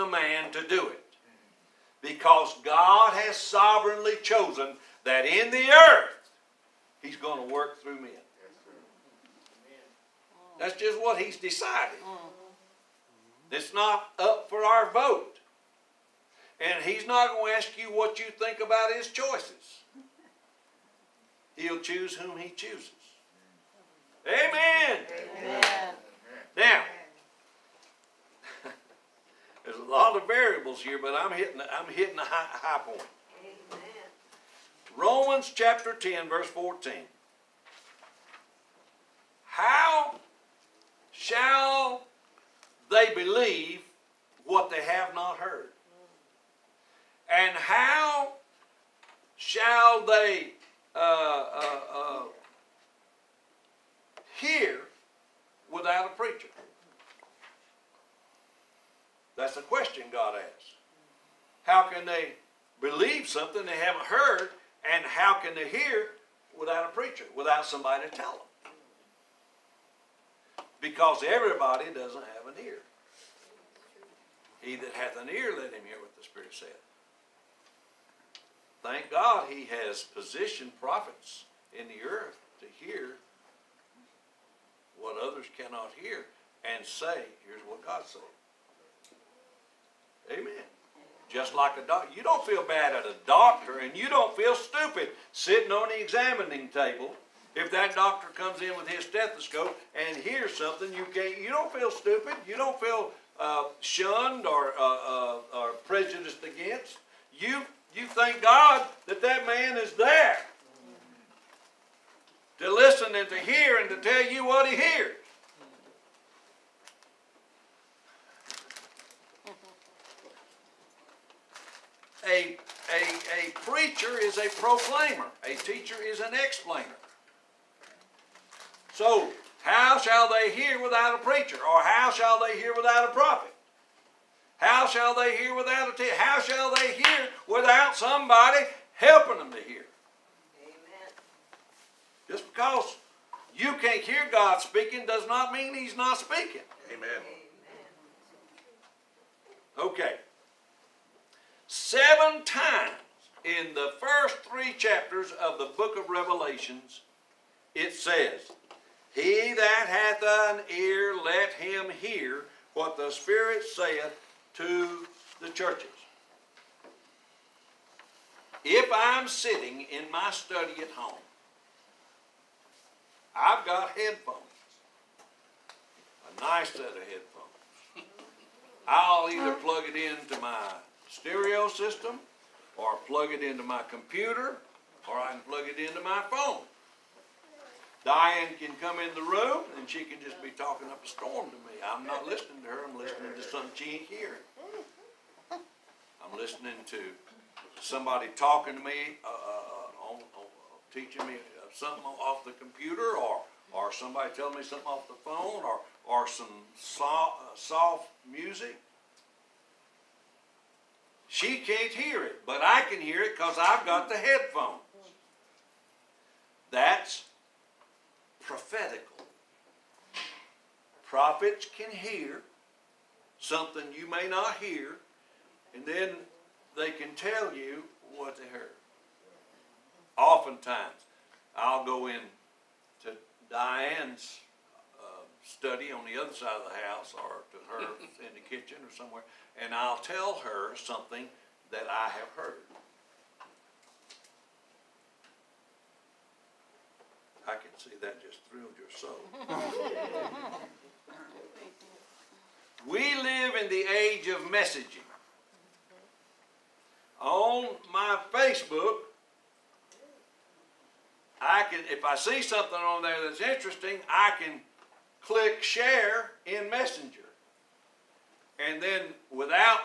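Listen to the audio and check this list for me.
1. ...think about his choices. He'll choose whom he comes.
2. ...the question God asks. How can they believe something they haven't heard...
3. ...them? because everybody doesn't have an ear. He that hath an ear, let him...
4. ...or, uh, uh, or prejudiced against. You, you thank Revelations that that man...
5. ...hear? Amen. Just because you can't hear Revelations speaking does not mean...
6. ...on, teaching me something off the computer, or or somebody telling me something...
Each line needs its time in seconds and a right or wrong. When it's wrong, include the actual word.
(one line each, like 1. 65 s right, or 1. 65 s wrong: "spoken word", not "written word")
1. 18 s wrong: "chooses", not "comes"
2. 59 s right
3. 68 s right
4. 104 s wrong: "God", not "Revelations"
5. 139 s wrong: "God", not "Revelations"
6. 200 s right.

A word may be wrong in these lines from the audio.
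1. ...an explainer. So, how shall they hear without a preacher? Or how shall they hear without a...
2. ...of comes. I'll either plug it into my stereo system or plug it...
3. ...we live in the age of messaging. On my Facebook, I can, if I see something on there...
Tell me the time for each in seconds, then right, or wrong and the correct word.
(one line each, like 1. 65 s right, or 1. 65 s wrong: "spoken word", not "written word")
1. 126 s right
2. 176 s wrong: "headphones", not "comes"
3. 252 s right.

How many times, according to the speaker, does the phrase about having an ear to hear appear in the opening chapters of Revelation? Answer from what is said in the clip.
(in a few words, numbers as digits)
7.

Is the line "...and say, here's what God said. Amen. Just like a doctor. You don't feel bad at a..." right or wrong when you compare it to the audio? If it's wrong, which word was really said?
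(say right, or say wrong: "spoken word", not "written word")
right.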